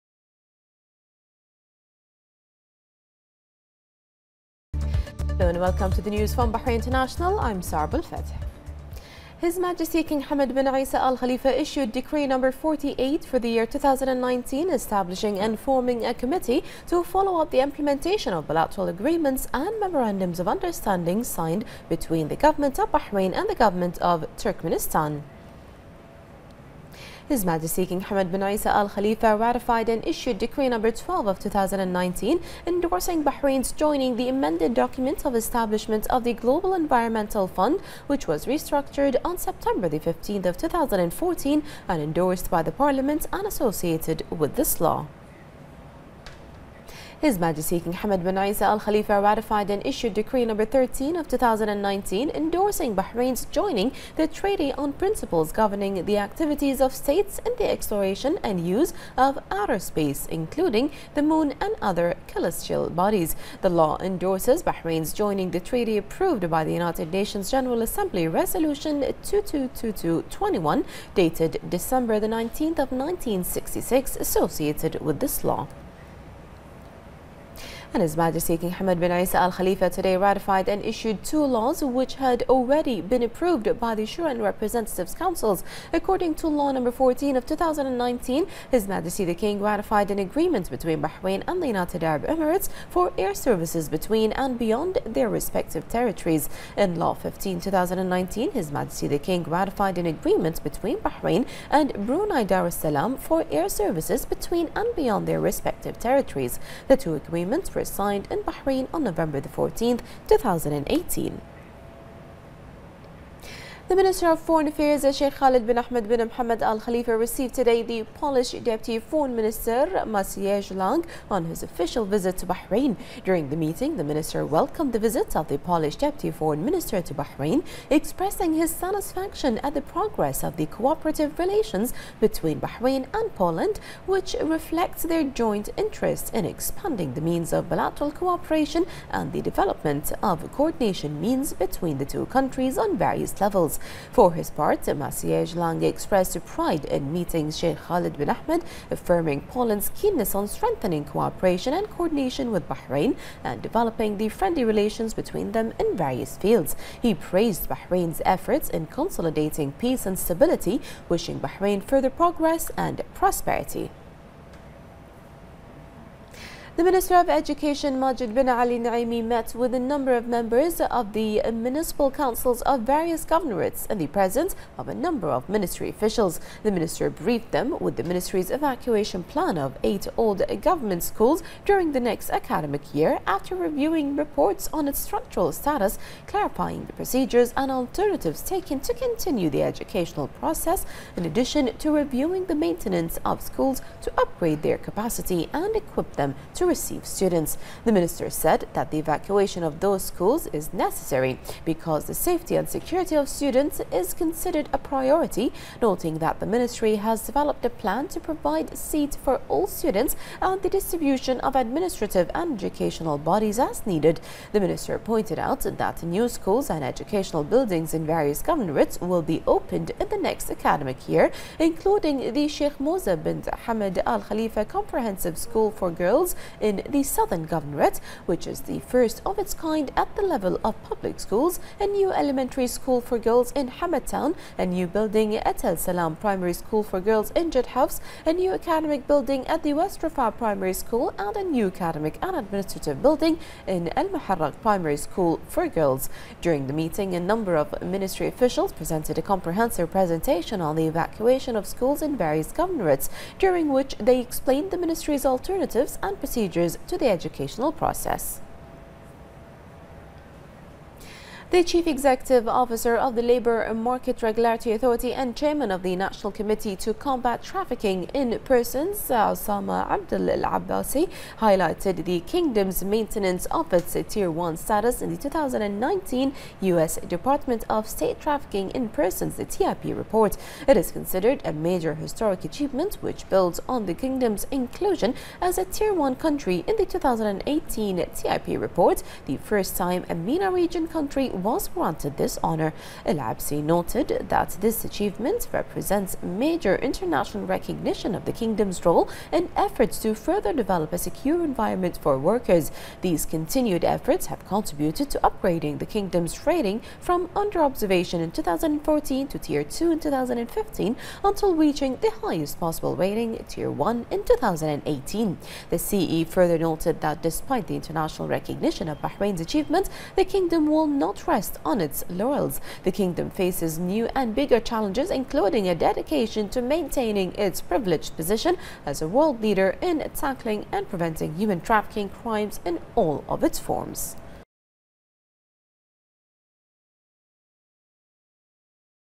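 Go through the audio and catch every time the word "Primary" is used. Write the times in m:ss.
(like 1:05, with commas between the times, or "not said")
3:56, 4:00, 4:04.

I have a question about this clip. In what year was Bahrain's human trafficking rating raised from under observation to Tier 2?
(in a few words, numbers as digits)
2015.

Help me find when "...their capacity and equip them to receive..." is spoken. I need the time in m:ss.
3:14.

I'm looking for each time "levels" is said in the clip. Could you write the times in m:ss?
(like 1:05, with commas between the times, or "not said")
2:23, 3:50.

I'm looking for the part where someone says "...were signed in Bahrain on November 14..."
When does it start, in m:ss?
1:47.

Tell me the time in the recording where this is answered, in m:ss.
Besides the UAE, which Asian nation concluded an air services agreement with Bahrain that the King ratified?
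1:42.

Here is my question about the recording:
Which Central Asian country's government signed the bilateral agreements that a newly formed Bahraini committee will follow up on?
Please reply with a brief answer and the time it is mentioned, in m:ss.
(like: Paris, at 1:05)
Turkmenistan, at 0:24.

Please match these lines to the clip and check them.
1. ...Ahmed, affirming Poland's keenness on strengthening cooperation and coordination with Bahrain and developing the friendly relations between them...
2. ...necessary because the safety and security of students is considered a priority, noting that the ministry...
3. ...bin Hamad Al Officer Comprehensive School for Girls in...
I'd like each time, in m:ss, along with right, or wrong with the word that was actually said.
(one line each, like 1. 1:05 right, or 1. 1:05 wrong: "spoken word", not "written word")
1. 2:28 right
2. 3:20 right
3. 3:43 wrong: "Khalifa", not "Officer".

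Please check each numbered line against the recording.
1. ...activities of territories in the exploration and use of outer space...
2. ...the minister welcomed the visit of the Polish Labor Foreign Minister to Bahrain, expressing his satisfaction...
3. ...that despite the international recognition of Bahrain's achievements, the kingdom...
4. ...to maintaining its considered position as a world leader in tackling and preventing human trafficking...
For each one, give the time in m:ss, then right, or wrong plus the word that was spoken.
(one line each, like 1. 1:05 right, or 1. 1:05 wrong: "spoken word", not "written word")
1. 0:56 wrong: "states", not "territories"
2. 2:03 wrong: "Deputy", not "Labor"
3. 5:17 right
4. 5:26 wrong: "privileged", not "considered".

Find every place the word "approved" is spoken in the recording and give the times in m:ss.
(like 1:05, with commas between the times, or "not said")
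1:05, 1:23.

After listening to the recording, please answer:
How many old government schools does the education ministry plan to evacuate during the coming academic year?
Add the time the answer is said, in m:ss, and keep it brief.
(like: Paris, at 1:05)
8, at 2:59.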